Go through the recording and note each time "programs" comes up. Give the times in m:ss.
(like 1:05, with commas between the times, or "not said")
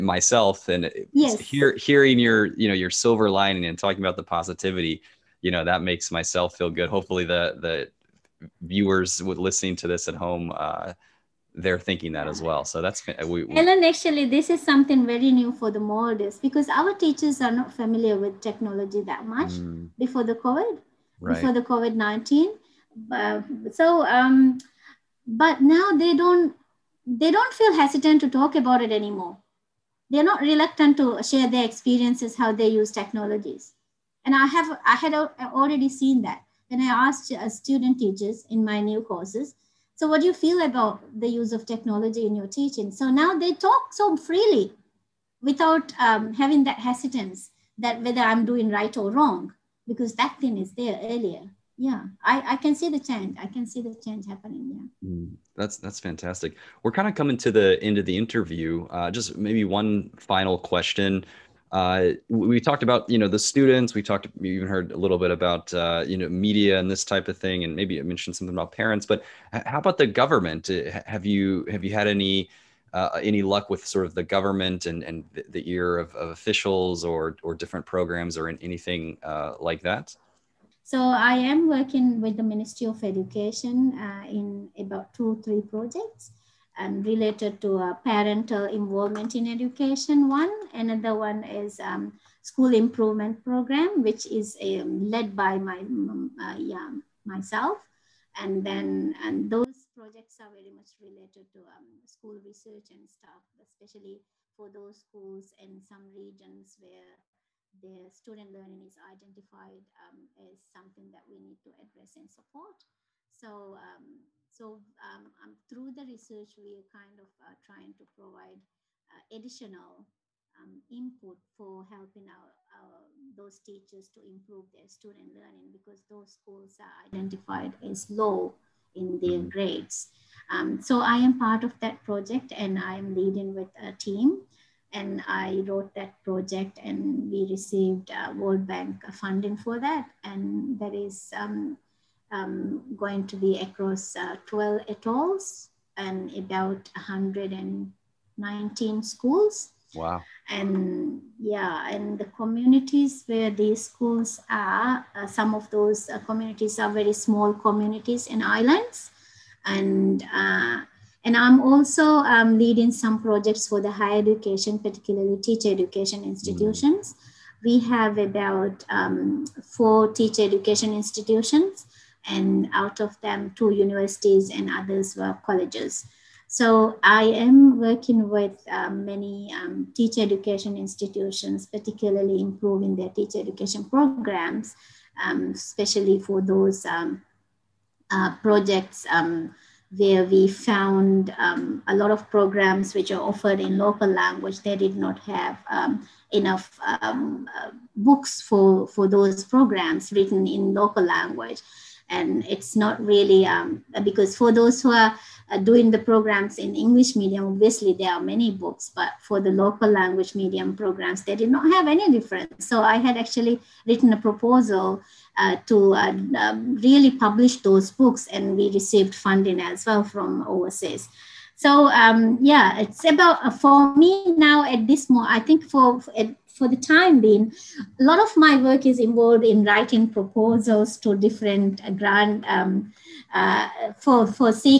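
1:17, 1:33, 3:03, 3:12, 3:19, 3:25, 3:30.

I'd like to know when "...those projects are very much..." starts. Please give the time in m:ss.
1:39.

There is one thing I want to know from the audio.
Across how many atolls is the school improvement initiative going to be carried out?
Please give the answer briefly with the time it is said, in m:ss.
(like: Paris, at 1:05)
12, at 2:24.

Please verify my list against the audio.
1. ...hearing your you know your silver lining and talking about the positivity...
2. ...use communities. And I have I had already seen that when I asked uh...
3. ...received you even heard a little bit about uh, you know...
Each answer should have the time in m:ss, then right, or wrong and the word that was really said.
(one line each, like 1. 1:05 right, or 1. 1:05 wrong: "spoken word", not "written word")
1. 0:01 right
2. 0:32 wrong: "technologies", not "communities"
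3. 1:04 wrong: "talked", not "received".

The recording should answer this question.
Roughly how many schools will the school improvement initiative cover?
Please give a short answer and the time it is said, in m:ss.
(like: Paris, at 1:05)
119, at 2:26.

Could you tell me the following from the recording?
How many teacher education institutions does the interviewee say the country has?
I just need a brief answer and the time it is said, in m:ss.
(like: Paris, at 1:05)
4, at 2:49.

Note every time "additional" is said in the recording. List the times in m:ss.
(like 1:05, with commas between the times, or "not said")
1:59.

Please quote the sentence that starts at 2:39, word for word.
And uh, and I'm also um, leading some projects for the higher education, particularly teacher education institutions.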